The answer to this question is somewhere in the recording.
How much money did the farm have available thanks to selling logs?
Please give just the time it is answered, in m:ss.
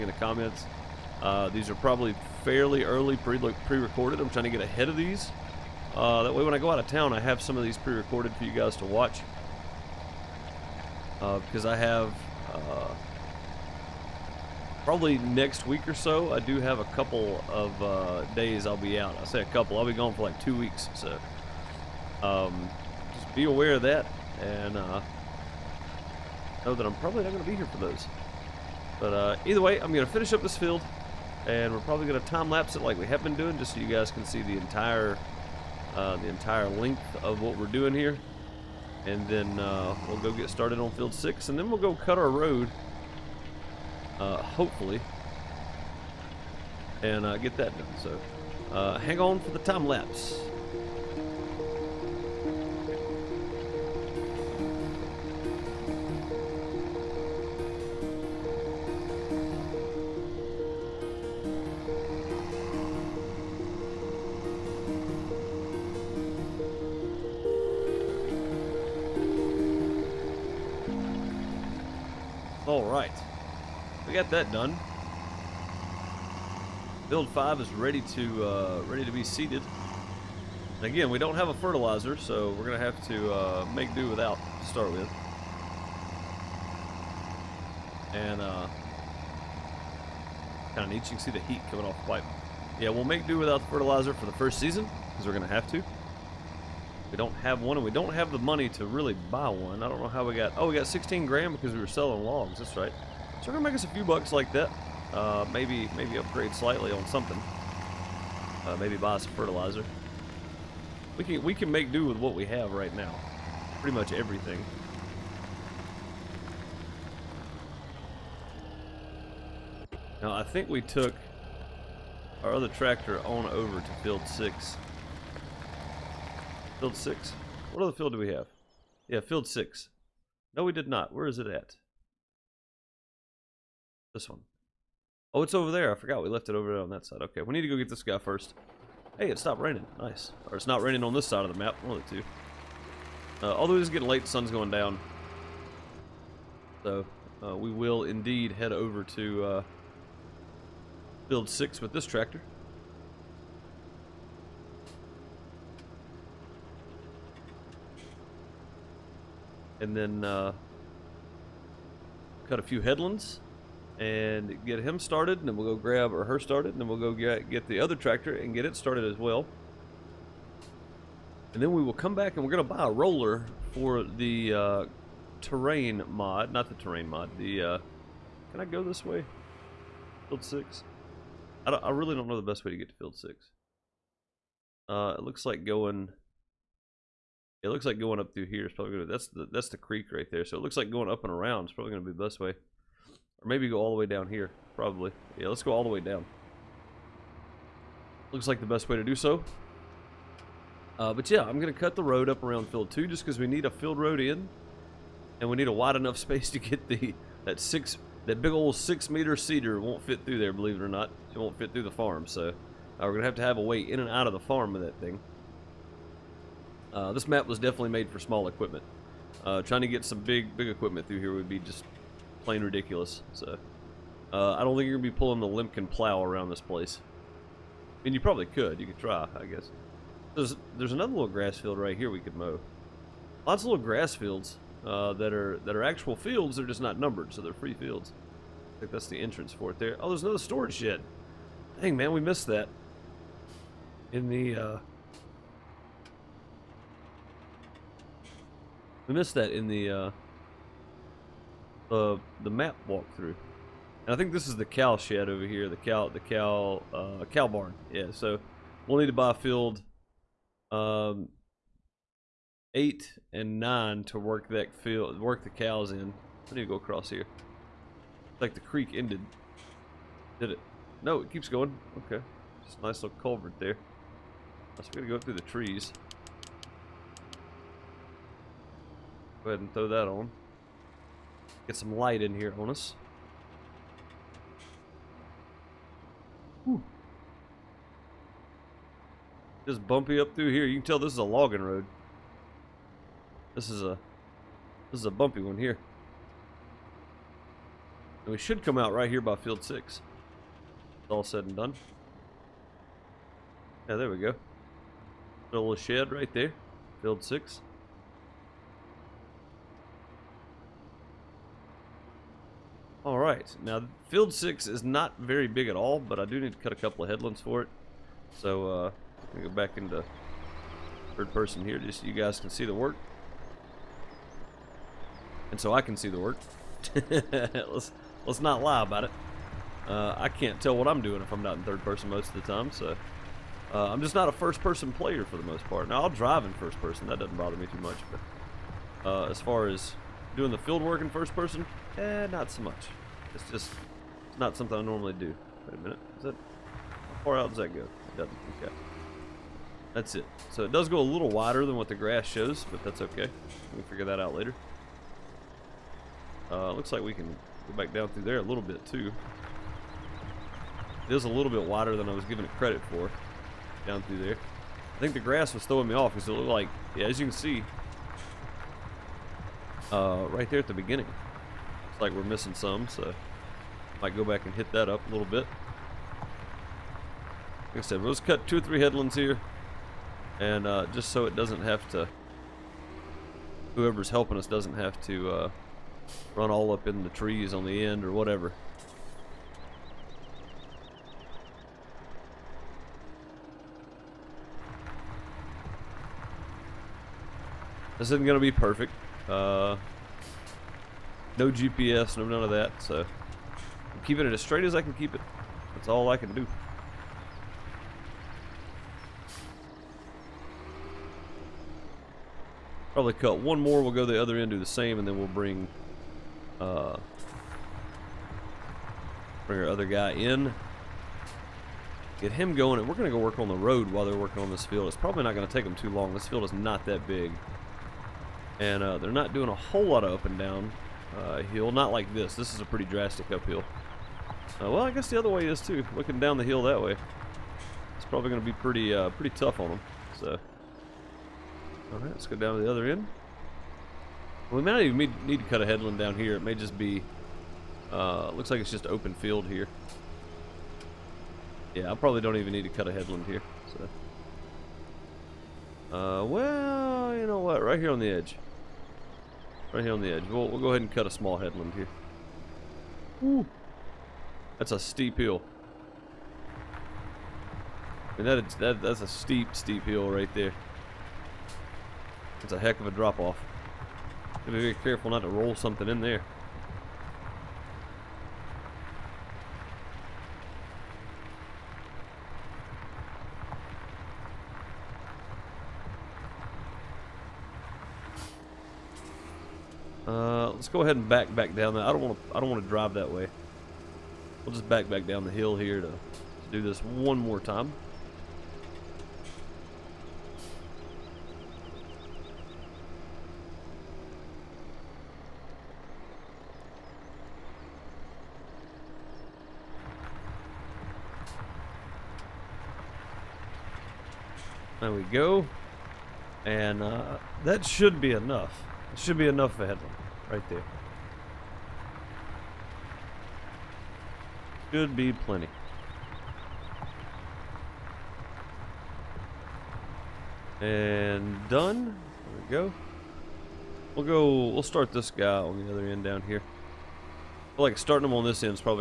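1:40.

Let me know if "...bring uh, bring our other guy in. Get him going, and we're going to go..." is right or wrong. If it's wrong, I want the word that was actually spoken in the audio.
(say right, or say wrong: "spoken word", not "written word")
right.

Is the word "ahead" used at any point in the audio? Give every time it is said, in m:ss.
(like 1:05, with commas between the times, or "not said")
0:04, 4:39, 7:40, 8:10.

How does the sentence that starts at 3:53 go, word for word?
Lots of little grass fields uh, that are that are actual fields.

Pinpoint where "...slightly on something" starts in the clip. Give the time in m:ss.
1:46.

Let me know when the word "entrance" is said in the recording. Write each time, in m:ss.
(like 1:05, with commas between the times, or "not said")
3:59.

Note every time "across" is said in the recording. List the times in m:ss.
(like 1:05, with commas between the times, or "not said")
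4:26.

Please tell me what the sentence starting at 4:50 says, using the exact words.
You can tell this is a logging road.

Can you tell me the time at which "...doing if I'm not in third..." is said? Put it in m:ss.
5:31.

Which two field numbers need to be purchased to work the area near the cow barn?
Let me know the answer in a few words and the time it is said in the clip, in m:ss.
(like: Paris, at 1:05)
8 and 9, at 4:22.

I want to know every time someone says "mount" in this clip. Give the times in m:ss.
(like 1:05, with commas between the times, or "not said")
not said.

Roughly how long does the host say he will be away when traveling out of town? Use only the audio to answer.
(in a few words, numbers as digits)
2 weeks.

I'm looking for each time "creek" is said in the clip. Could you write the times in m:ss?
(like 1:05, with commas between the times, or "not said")
3:09, 4:28.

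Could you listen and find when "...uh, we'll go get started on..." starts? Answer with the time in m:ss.
0:39.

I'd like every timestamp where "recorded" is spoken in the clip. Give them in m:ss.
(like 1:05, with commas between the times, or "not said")
0:03, 0:07.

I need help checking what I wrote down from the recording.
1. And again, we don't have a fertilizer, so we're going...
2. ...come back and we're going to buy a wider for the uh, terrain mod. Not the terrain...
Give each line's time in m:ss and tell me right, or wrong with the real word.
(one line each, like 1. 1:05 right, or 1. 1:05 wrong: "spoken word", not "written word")
1. 1:20 right
2. 2:51 wrong: "roller", not "wider".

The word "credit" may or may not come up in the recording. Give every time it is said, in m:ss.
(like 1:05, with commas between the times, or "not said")
6:02.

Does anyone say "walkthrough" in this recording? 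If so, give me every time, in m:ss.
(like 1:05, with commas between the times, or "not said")
4:12.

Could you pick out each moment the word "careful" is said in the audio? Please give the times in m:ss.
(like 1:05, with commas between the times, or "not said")
7:54.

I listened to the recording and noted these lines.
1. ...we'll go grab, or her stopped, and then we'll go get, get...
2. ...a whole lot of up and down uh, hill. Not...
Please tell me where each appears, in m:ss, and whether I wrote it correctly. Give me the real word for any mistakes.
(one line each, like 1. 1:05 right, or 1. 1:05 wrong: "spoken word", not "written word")
1. 2:45 wrong: "started", not "stopped"
2. 7:09 right.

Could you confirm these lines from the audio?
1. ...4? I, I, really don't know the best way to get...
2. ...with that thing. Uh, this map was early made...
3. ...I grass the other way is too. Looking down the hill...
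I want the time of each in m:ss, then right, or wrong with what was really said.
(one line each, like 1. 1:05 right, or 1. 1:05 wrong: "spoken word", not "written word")
1. 3:00 wrong: "6", not "4"
2. 3:34 wrong: "definitely", not "early"
3. 7:14 wrong: "guess", not "grass".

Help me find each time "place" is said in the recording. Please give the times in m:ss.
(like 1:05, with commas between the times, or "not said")
3:46.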